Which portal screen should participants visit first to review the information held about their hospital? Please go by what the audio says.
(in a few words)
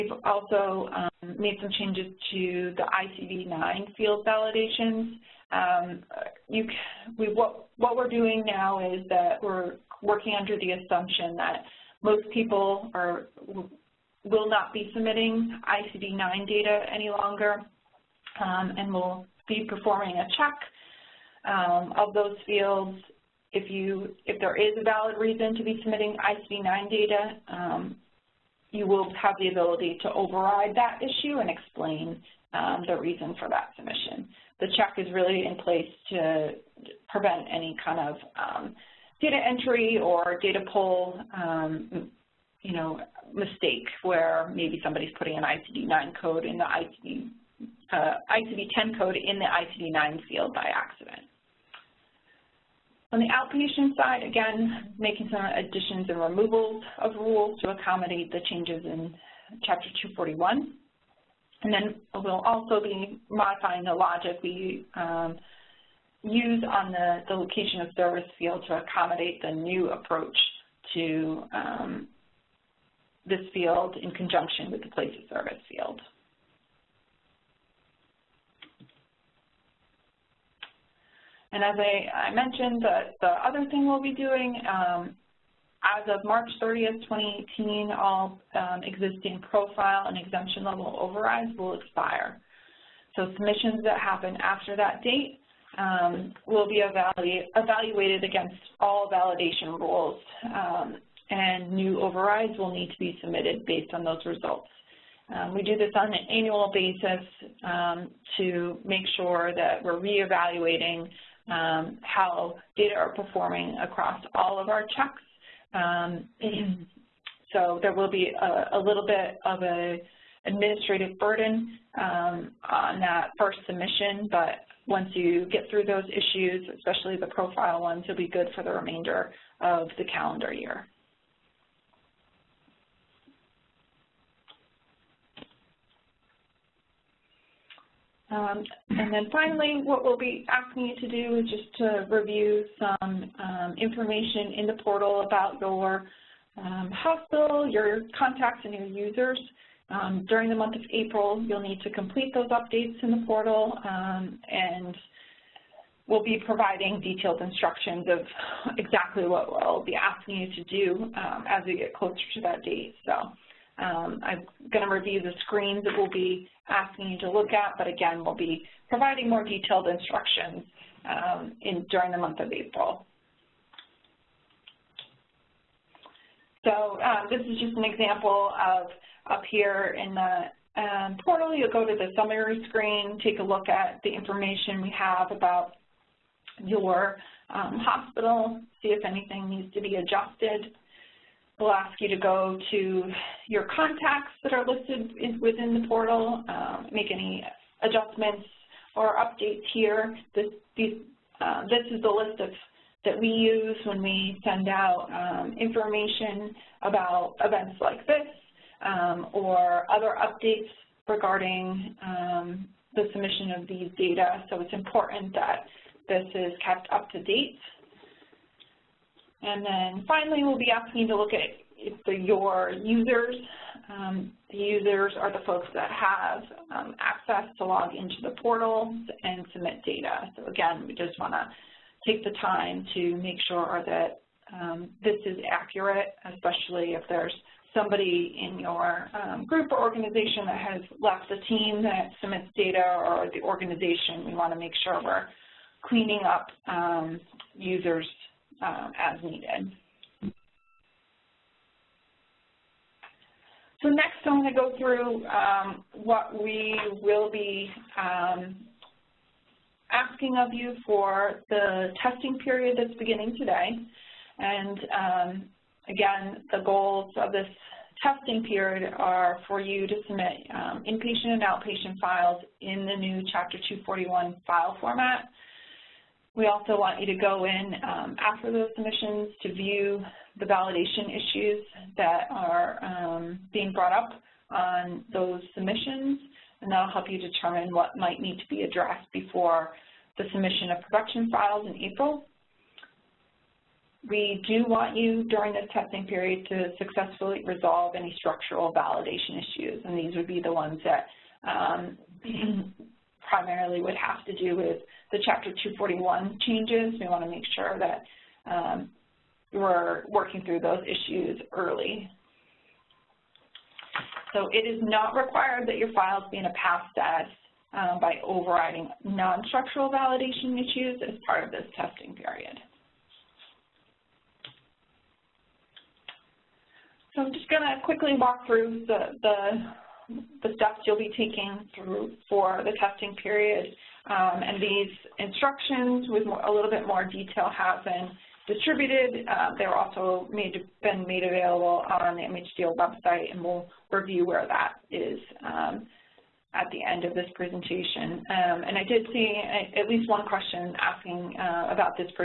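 Summary screen.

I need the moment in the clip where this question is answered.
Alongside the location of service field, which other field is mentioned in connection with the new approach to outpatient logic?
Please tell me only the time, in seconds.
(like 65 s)
74 s.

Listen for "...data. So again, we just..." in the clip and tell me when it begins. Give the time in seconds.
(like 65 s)
229 s.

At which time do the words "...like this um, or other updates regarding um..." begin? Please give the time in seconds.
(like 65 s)
207 s.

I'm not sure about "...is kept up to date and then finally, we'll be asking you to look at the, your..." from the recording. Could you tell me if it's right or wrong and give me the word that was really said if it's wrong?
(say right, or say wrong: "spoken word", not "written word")
right.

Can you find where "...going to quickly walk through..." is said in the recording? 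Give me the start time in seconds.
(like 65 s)
327 s.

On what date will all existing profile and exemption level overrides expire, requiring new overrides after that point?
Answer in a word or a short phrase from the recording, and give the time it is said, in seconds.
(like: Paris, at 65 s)
March 30th, 2018, at 86 s.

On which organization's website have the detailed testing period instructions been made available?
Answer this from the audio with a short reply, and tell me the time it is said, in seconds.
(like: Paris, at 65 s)
MHDO, at 342 s.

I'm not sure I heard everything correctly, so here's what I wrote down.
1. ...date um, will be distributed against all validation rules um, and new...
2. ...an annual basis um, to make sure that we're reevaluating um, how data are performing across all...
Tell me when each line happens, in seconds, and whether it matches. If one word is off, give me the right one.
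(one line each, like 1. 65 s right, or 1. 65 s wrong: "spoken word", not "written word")
1. 95 s wrong: "evaluated", not "distributed"
2. 106 s right.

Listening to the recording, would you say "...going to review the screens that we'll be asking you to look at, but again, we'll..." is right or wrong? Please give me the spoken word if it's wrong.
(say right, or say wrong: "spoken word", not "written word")
right.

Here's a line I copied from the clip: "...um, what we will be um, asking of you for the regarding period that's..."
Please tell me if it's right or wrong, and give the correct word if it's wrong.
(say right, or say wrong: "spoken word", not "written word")
wrong: "testing", not "regarding".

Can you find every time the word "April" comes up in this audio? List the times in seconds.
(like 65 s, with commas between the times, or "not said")
150 s, 172 s, 291 s.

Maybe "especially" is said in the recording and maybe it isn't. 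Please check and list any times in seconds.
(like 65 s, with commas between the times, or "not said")
126 s, 236 s.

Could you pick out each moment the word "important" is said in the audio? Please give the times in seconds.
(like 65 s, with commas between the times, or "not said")
214 s.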